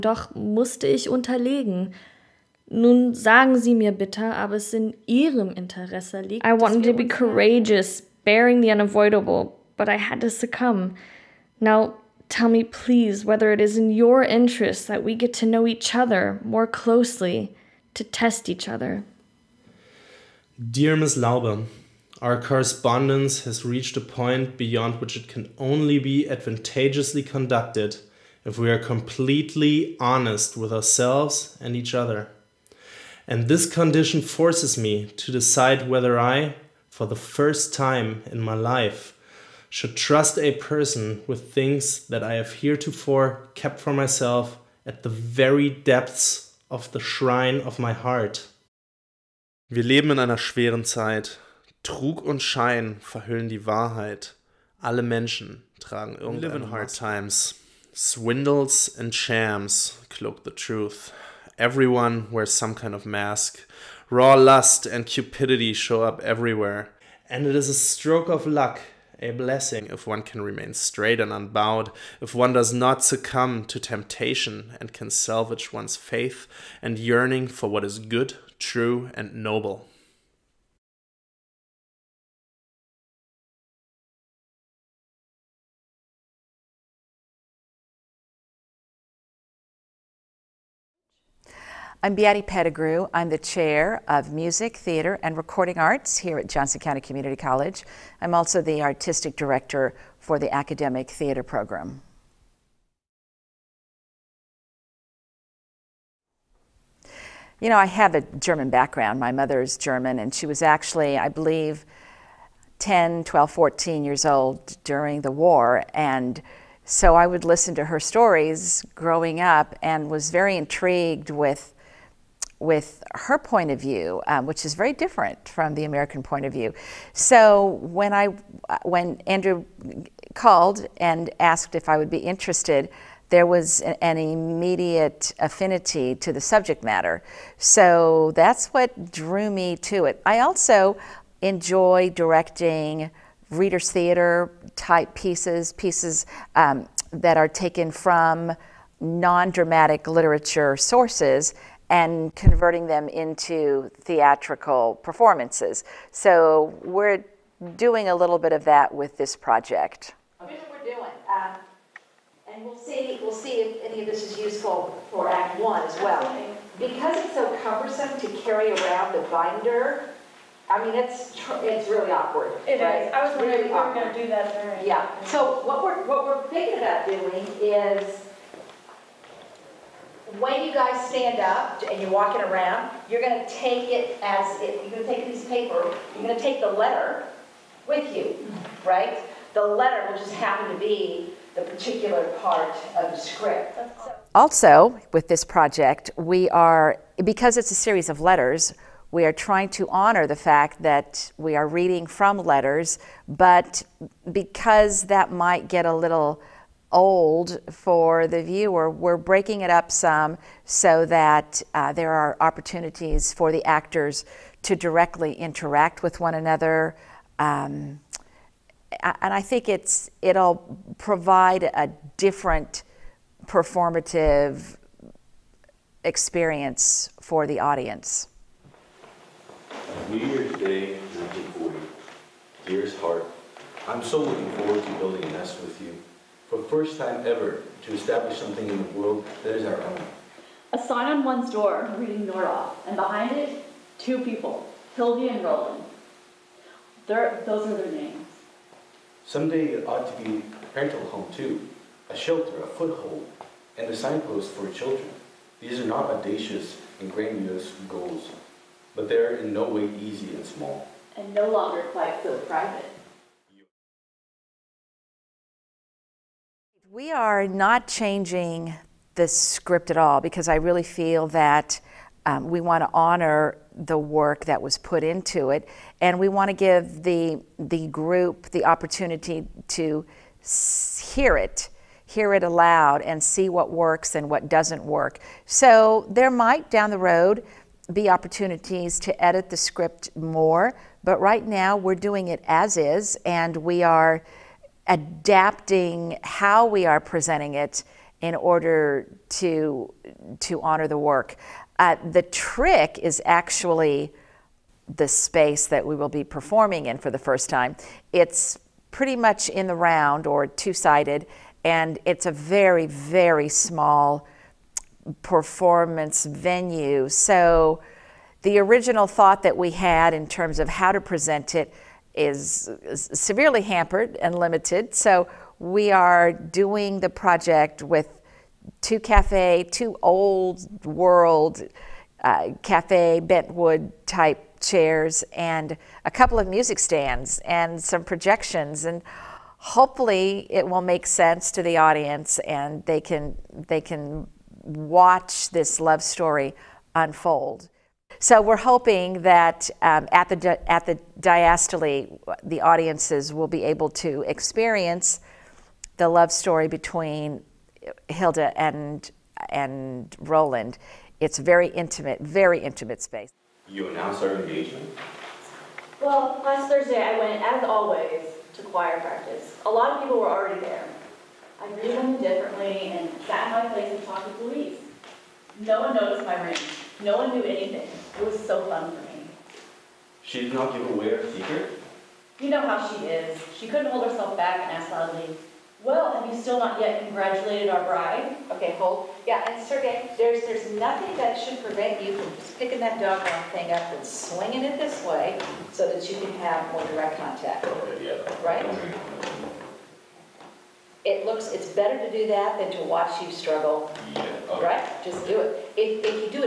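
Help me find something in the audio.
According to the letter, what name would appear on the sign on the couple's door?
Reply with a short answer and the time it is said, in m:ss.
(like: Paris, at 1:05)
Nora, at 4:02.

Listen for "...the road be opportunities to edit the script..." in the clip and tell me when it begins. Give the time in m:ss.
4:46.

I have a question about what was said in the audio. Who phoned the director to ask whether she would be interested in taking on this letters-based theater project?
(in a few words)
Andrew.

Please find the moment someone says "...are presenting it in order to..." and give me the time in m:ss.
4:56.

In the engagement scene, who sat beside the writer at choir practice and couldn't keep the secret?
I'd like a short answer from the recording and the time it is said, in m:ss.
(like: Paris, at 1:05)
Louise, at 6:14.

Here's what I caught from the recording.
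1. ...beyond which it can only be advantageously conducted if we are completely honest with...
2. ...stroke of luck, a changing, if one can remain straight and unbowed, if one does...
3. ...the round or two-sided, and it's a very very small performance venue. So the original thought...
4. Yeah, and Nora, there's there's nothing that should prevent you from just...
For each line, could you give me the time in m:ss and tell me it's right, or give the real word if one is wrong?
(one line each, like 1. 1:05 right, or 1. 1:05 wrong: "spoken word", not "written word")
1. 0:24 right
2. 1:07 wrong: "blessing", not "changing"
3. 5:09 right
4. 6:29 wrong: "Sergey", not "Nora".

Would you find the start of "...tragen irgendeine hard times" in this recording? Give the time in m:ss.
0:55.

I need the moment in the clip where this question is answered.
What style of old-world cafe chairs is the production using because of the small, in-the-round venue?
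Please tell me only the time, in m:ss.
5:33.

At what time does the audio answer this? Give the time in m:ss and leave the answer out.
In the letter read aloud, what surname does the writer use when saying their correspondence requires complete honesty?
0:21.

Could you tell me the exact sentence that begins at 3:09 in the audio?
The letter will just happen to be the particular part of the script.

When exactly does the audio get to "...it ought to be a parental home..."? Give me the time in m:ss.
4:09.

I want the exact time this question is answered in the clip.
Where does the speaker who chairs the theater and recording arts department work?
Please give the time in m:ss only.
1:36.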